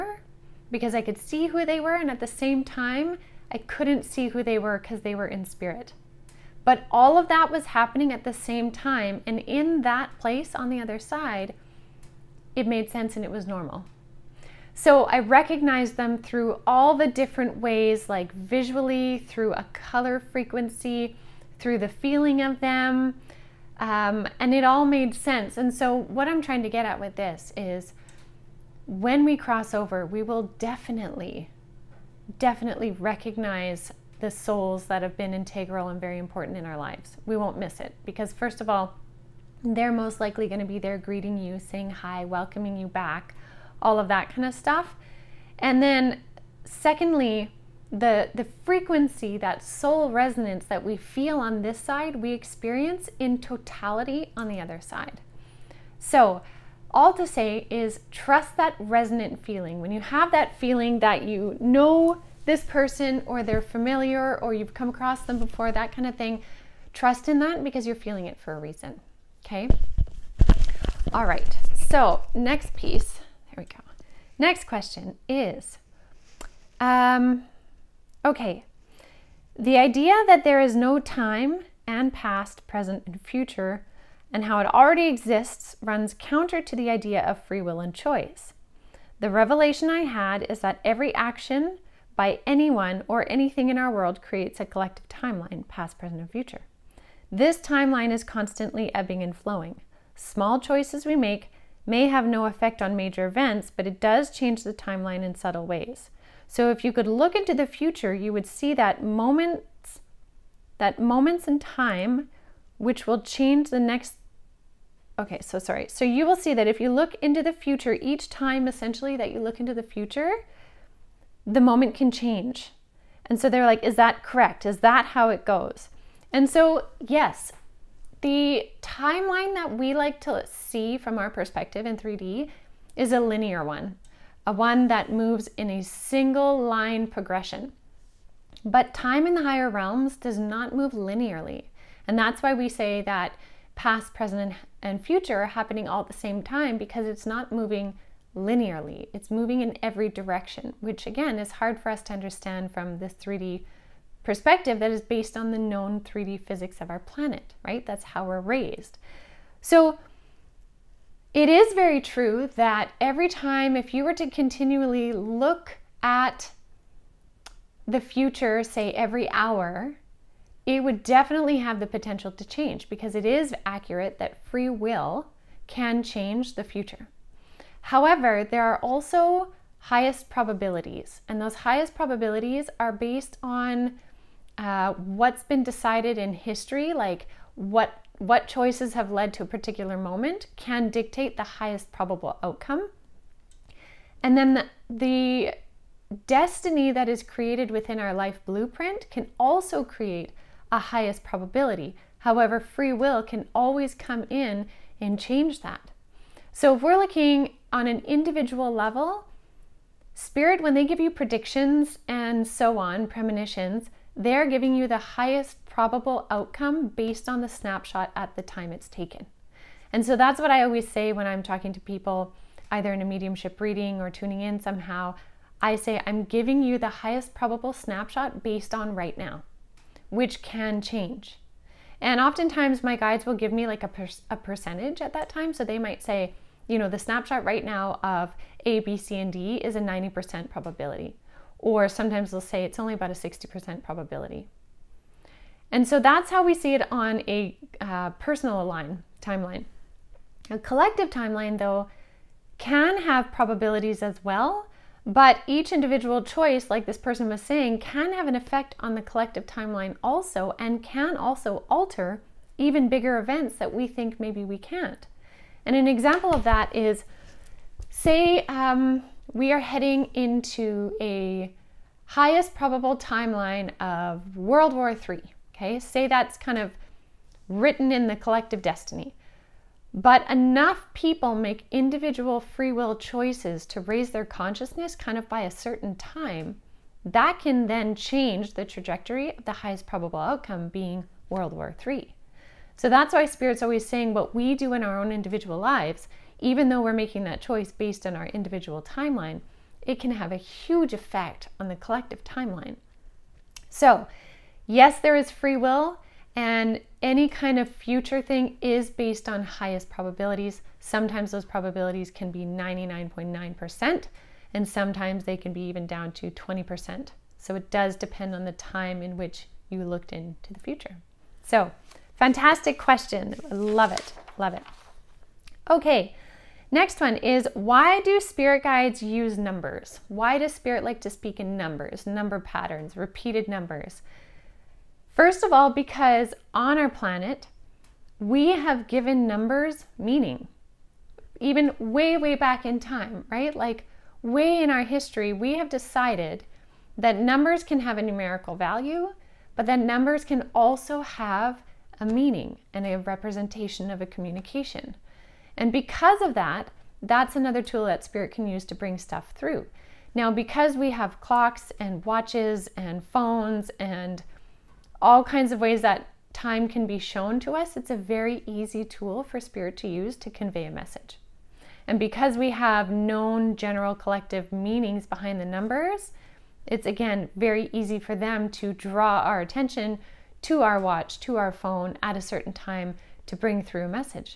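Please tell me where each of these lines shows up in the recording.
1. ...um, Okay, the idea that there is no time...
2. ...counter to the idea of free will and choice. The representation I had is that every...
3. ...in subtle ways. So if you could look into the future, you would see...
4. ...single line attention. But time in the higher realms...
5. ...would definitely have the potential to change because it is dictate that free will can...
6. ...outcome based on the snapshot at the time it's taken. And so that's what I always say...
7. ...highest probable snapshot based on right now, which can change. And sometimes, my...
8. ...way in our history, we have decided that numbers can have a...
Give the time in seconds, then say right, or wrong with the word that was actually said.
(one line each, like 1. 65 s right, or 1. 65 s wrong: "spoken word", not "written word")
1. 76 s right
2. 86 s wrong: "revelation", not "representation"
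3. 105 s right
4. 135 s wrong: "progression", not "attention"
5. 170 s wrong: "accurate", not "dictate"
6. 216 s right
7. 226 s wrong: "oftentimes", not "sometimes"
8. 344 s right.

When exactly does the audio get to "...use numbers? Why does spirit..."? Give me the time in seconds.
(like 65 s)
329 s.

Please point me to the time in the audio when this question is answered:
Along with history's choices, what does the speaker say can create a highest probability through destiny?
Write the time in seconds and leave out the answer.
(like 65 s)
198 s.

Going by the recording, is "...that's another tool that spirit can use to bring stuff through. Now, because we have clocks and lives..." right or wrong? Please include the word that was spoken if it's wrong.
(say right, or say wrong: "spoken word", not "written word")
wrong: "watches", not "lives".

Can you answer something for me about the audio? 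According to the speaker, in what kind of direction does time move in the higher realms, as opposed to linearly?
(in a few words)
every direction.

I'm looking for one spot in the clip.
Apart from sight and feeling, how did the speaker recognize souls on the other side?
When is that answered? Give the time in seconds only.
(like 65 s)
19 s.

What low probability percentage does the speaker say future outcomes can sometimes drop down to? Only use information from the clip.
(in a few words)
20%.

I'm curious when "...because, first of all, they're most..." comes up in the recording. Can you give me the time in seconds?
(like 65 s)
38 s.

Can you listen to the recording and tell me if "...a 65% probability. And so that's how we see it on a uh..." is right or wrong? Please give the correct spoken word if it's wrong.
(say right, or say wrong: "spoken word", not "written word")
wrong: "60", not "65".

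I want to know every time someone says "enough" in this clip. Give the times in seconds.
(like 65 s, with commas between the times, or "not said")
280 s.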